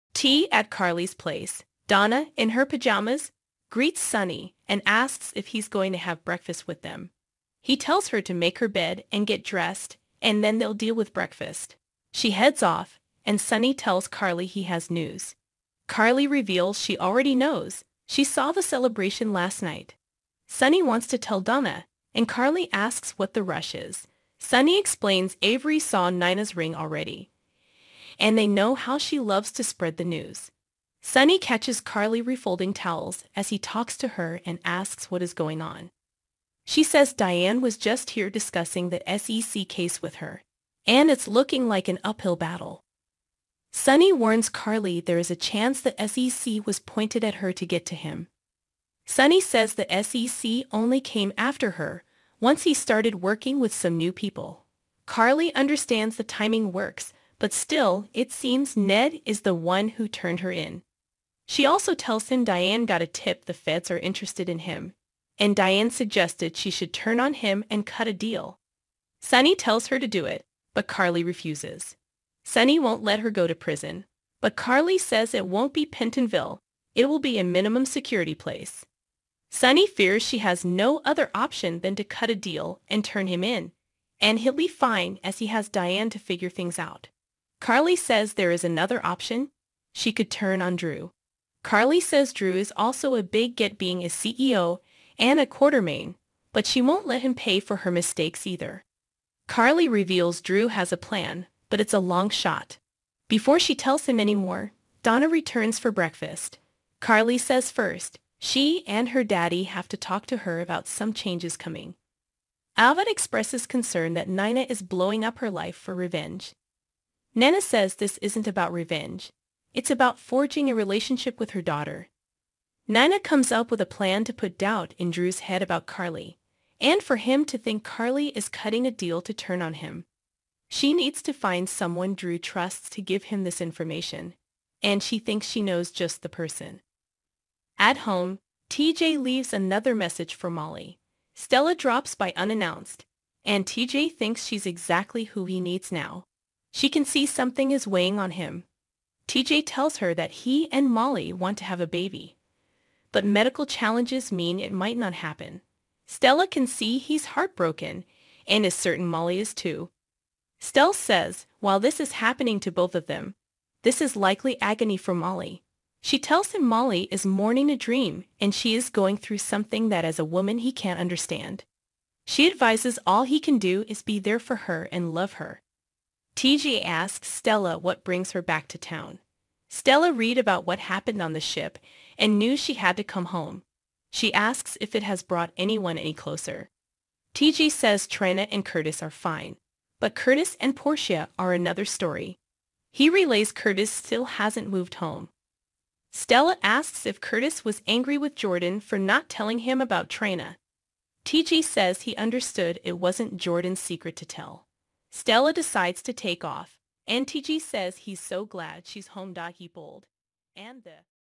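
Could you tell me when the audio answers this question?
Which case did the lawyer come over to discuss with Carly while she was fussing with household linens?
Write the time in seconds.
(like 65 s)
38 s.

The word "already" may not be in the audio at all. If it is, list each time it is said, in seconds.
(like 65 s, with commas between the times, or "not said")
16 s, 26 s.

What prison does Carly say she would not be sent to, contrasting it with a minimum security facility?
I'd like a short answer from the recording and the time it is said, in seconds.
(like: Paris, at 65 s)
Pentonville, at 75 s.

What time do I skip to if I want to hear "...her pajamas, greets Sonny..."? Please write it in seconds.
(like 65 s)
2 s.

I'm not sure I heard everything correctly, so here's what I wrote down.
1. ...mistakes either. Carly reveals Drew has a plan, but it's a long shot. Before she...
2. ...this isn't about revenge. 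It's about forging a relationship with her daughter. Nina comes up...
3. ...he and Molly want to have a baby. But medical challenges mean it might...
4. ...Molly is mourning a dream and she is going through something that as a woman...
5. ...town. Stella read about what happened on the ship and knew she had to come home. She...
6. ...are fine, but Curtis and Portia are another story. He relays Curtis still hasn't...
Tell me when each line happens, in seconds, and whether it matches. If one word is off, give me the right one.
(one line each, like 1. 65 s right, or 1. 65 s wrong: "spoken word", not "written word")
1. 97 s right
2. 117 s right
3. 150 s right
4. 166 s right
5. 178 s right
6. 189 s right.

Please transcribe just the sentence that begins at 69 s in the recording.
Sonny tells her to do it, but Carly refuses.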